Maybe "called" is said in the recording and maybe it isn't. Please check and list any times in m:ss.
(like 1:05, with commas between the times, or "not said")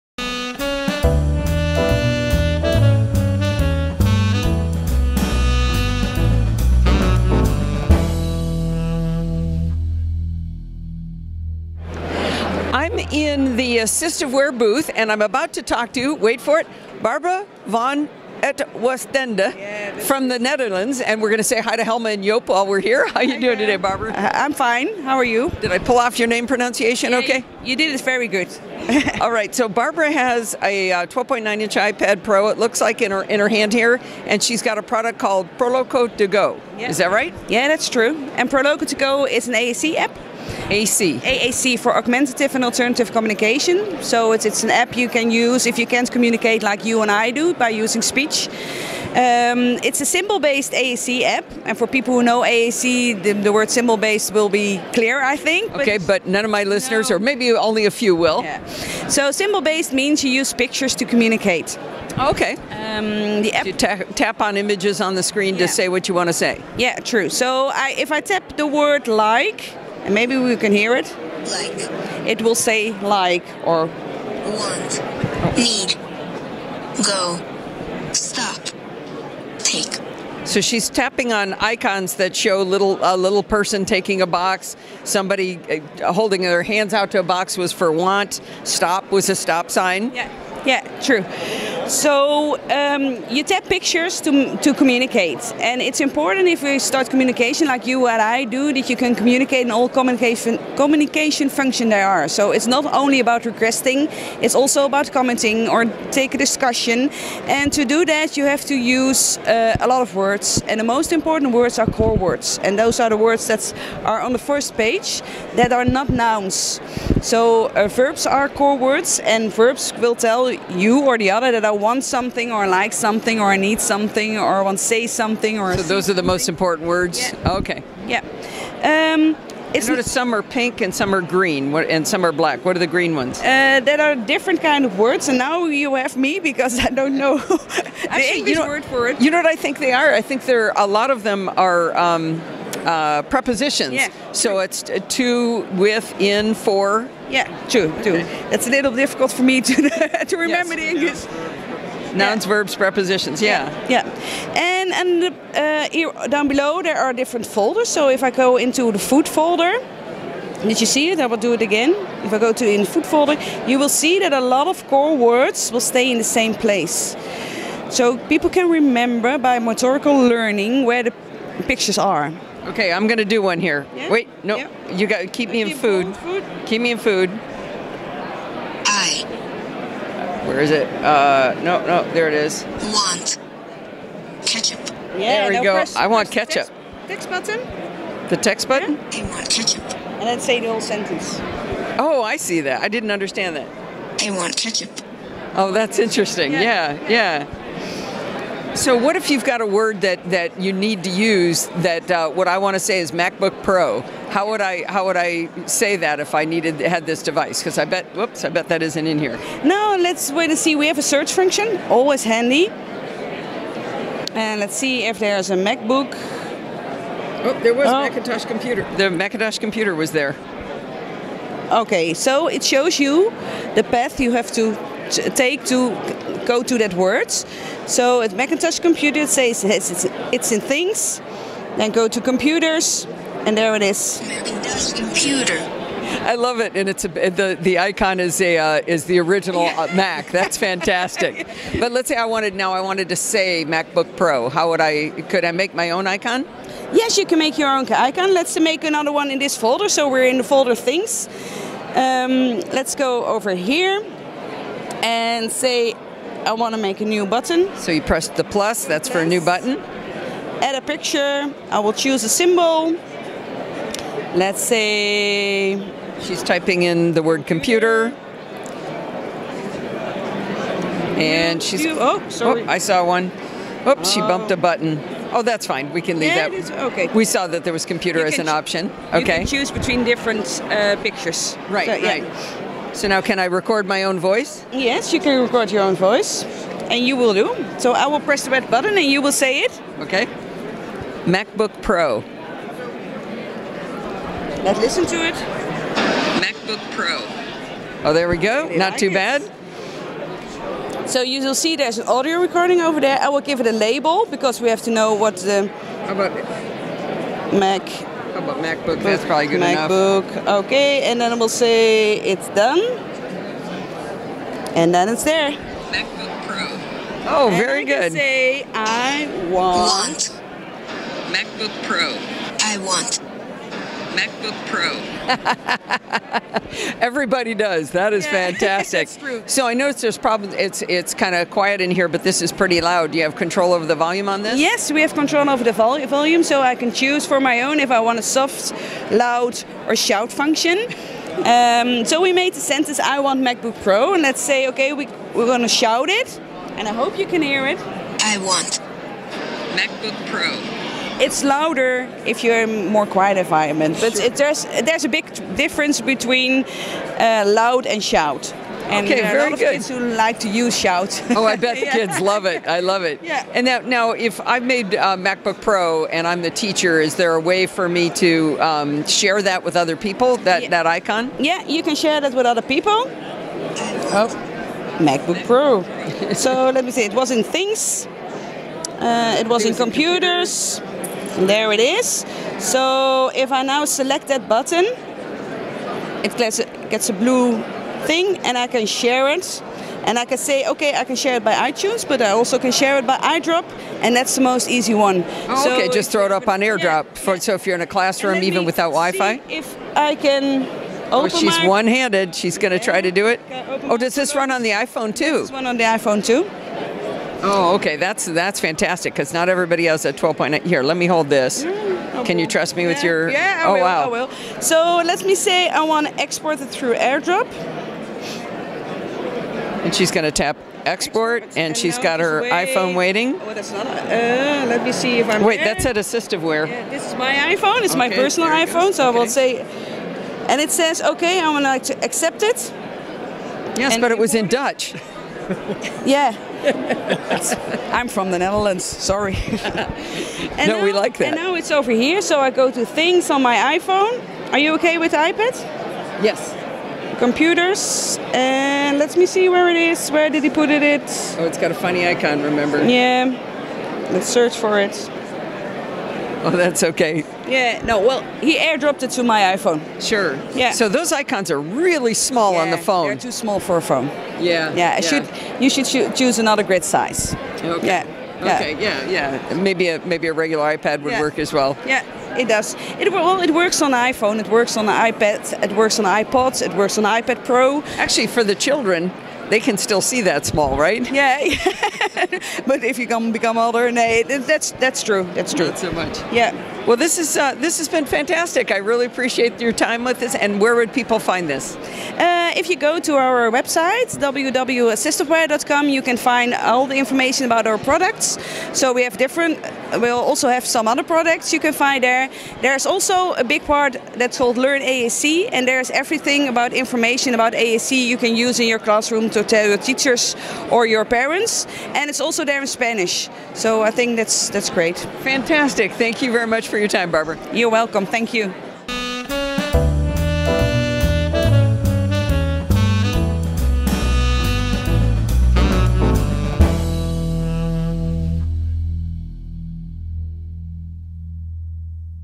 0:35, 8:24.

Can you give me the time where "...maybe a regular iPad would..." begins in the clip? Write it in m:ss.
7:50.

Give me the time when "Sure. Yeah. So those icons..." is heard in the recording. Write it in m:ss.
7:40.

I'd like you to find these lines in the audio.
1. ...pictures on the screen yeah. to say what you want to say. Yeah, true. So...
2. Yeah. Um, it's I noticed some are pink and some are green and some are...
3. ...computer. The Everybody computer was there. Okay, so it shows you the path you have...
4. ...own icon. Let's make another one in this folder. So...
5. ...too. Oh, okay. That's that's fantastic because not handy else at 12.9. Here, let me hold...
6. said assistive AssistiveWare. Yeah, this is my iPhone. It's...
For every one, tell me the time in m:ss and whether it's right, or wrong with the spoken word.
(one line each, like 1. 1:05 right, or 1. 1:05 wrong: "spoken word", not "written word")
1. 1:04 wrong: "images", not "pictures"
2. 2:08 right
3. 3:38 wrong: "Macintosh", not "Everybody"
4. 4:07 right
5. 6:46 wrong: "everybody", not "handy"
6. 7:05 right.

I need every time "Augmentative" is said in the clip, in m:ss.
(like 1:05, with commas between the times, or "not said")
0:41.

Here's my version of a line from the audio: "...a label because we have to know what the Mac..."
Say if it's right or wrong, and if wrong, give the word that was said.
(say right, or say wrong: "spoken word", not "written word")
right.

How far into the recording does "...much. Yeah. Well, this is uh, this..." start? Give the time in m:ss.
8:05.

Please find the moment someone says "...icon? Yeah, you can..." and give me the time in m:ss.
6:10.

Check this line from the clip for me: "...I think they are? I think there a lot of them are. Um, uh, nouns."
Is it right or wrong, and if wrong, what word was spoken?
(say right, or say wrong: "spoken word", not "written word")
wrong: "prepositions", not "nouns".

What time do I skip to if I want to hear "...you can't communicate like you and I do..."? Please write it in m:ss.
0:45.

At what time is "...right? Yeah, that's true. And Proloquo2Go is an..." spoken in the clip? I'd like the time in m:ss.
0:37.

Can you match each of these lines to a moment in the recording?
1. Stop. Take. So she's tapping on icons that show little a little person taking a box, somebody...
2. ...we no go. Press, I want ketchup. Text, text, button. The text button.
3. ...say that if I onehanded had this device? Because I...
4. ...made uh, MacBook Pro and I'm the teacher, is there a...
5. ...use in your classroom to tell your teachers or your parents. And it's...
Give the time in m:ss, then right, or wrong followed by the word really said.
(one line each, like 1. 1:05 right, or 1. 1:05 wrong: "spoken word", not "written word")
1. 1:18 right
2. 3:05 right
3. 3:25 wrong: "needed", not "onehanded"
4. 6:04 right
5. 8:28 right.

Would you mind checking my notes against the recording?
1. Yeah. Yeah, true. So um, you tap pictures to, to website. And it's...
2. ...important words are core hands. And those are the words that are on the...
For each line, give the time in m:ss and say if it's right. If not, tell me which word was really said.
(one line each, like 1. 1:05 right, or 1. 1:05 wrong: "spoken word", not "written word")
1. 1:30 wrong: "communicate", not "website"
2. 1:51 wrong: "words", not "hands".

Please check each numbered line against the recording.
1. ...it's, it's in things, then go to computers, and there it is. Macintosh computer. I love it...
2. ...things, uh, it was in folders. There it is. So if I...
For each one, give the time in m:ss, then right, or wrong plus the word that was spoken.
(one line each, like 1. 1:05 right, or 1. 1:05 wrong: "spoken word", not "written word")
1. 3:49 right
2. 6:17 wrong: "computers", not "folders".